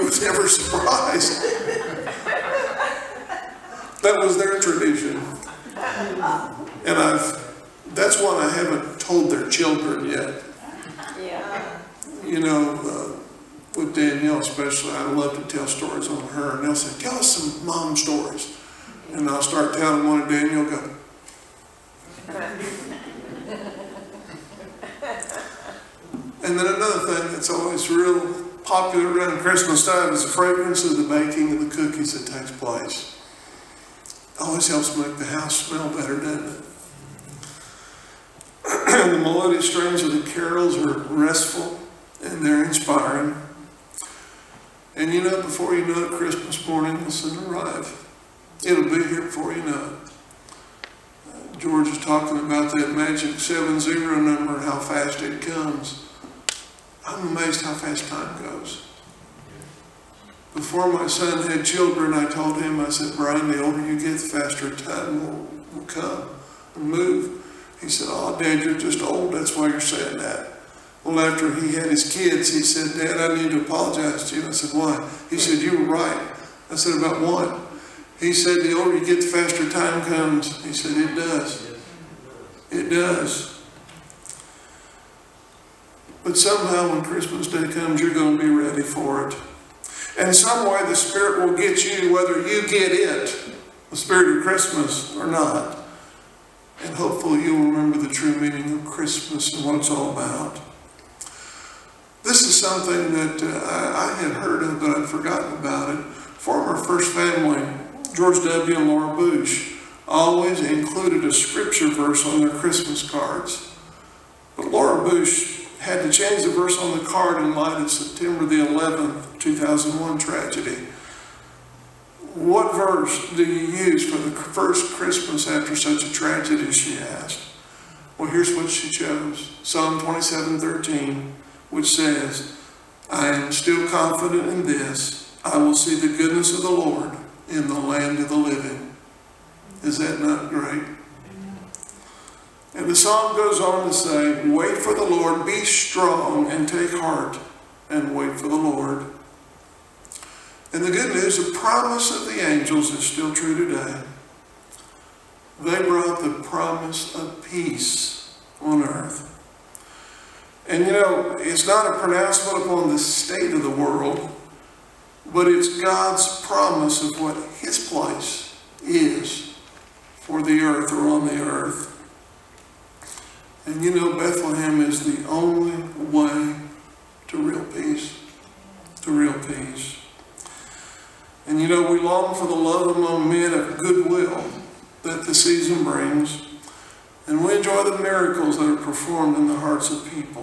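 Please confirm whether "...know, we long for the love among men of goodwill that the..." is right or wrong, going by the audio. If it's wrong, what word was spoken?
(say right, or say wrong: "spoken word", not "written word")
right.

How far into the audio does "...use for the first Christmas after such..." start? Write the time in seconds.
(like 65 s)
123 s.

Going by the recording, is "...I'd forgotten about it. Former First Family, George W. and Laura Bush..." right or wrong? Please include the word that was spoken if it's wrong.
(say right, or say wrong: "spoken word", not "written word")
right.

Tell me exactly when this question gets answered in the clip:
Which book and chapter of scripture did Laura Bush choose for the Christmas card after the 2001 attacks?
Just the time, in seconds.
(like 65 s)
129 s.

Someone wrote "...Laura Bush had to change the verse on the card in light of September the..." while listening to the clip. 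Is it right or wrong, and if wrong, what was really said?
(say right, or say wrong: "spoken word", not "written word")
right.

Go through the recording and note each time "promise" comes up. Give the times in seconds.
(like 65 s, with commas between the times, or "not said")
151 s, 156 s, 166 s.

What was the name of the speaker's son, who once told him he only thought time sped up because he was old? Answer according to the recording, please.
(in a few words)
Brian.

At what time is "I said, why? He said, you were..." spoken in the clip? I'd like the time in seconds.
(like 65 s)
74 s.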